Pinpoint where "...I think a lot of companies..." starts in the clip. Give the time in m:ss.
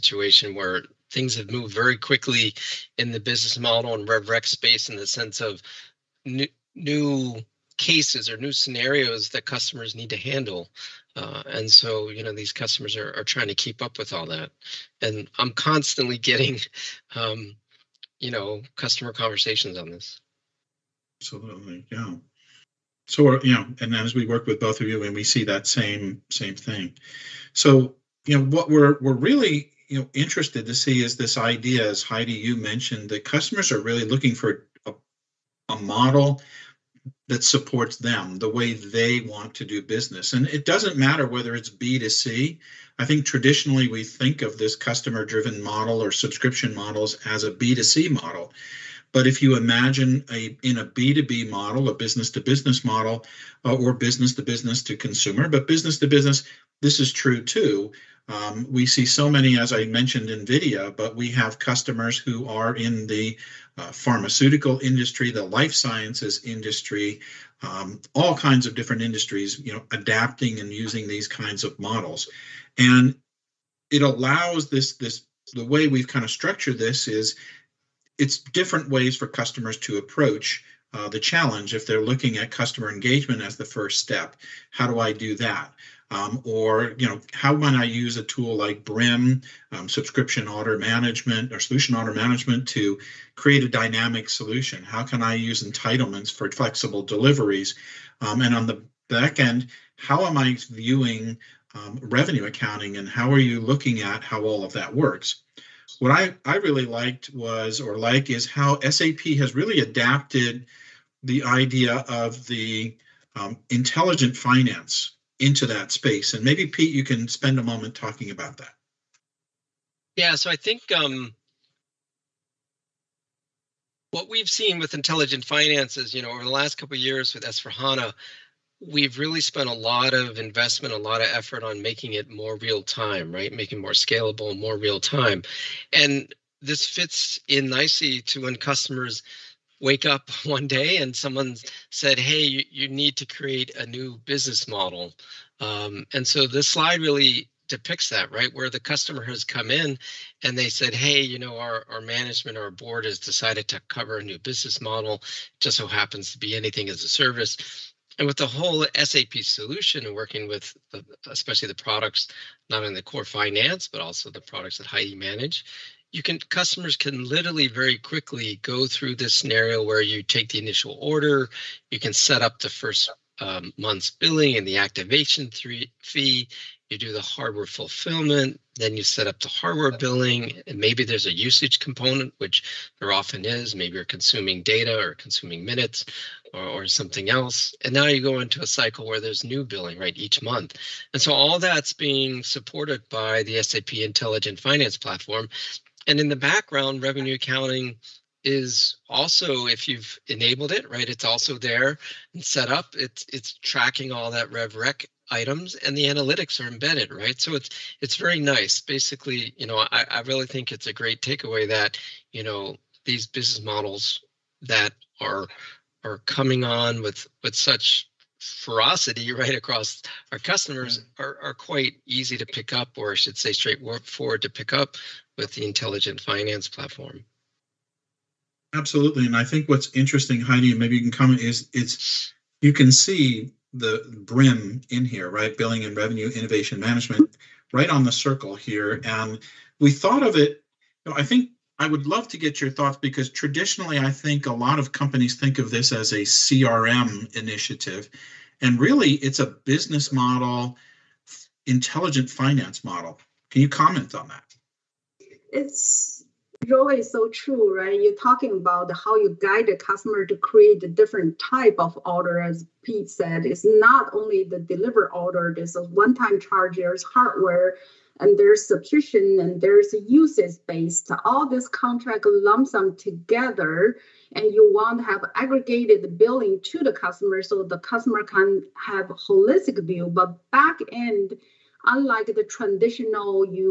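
4:03.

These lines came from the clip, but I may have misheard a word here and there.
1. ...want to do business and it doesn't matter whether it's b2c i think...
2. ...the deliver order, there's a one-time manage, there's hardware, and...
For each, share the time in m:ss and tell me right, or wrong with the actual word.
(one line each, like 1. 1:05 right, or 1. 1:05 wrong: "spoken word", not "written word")
1. 0:39 right
2. 4:24 wrong: "charge", not "manage".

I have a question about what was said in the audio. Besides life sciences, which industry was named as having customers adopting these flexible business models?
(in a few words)
Pharmaceutical.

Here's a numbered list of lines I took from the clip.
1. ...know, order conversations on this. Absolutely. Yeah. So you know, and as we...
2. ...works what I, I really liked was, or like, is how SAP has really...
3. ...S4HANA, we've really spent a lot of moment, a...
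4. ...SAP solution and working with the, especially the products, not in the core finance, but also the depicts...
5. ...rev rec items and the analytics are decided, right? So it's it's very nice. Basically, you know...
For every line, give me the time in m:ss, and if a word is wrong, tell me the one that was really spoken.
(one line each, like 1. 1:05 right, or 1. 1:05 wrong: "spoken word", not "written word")
1. 0:18 wrong: "customer", not "order"
2. 1:44 right
3. 2:07 wrong: "investment", not "moment"
4. 2:38 wrong: "products", not "depicts"
5. 3:24 wrong: "embedded", not "decided".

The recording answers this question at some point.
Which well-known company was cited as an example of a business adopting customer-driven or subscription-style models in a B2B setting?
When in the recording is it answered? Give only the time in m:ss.
1:00.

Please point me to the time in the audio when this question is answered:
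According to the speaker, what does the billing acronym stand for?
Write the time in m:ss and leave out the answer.
3:55.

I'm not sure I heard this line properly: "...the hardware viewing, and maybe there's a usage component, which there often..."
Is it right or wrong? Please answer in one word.
wrong.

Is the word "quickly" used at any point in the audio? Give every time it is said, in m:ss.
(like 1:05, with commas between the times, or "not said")
0:01, 2:47.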